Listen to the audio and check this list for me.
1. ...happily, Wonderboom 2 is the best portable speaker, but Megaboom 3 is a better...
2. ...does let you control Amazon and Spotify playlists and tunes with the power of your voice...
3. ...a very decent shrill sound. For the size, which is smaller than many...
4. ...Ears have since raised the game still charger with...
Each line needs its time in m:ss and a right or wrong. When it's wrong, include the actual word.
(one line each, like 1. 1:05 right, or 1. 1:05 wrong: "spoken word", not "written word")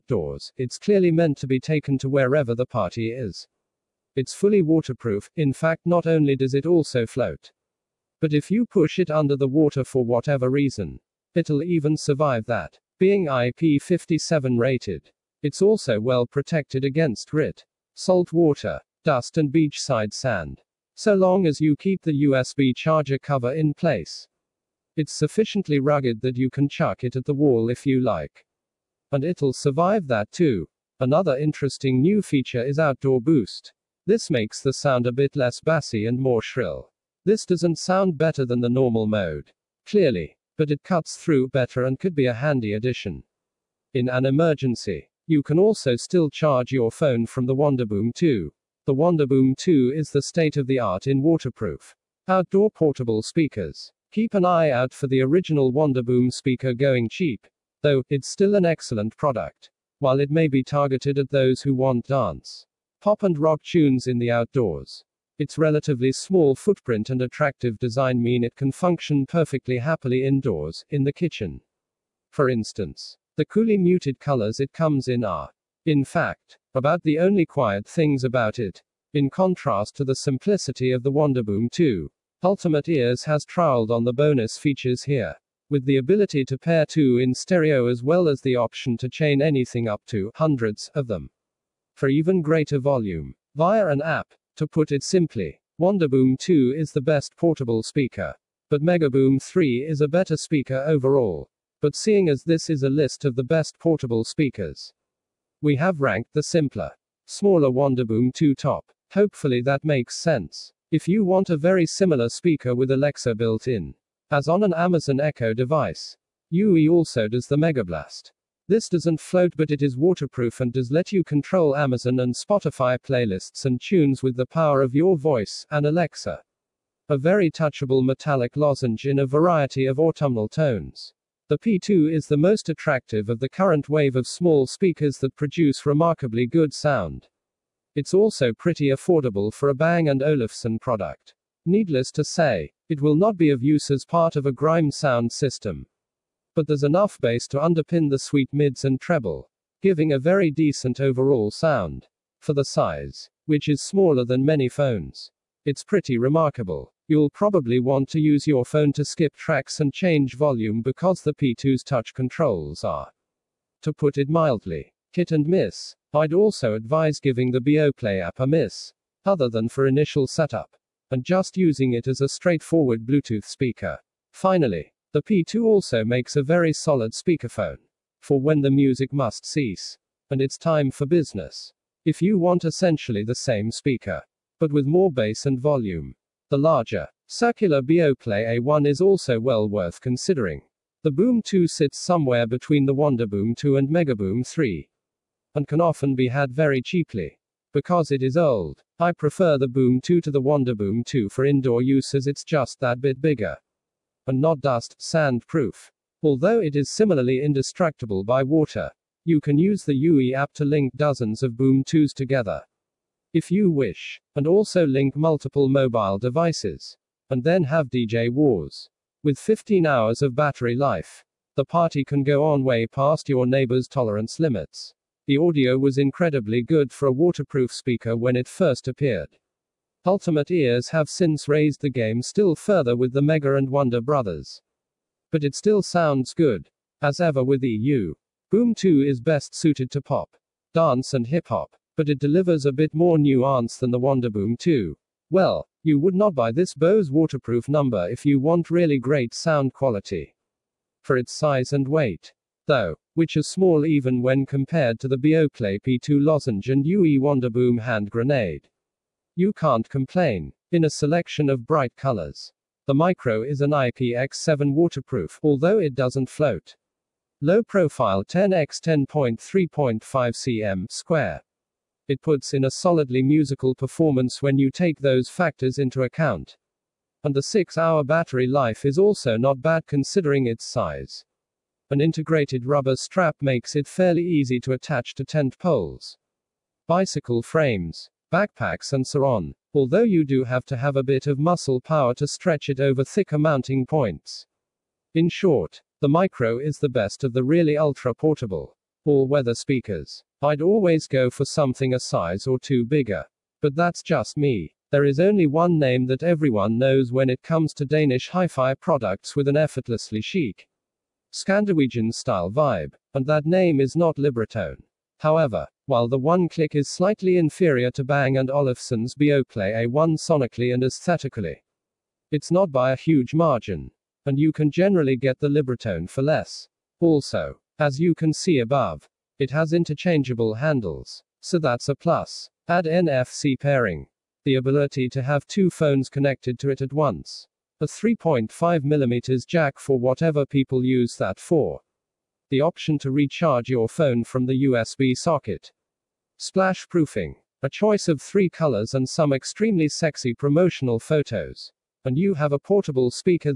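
1. 1:35 wrong: "simply", not "happily"
2. 2:00 right
3. 2:30 wrong: "overall", not "shrill"
4. 3:50 wrong: "further", not "charger".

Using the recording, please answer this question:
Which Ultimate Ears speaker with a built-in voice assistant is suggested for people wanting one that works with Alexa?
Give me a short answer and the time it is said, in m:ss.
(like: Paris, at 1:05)
Megablast, at 1:57.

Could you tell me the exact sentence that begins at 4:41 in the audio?
An integrated rubber strap makes it fairly easy to attach to tent poles.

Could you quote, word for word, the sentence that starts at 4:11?
For its size and weight, though, which is small even when compared to the Beoplay P2 lozenge and UE Wonderboom hand grenade.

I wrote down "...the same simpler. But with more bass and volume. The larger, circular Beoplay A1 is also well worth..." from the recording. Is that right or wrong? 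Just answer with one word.
wrong.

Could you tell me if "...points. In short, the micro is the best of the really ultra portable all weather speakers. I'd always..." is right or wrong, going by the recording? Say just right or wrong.
right.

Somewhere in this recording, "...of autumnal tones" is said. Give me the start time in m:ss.
2:09.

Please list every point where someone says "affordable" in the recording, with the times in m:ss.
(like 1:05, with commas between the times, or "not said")
2:18.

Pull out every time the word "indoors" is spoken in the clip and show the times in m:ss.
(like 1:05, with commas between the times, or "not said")
1:10, 3:21.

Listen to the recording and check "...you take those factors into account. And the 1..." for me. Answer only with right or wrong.
wrong.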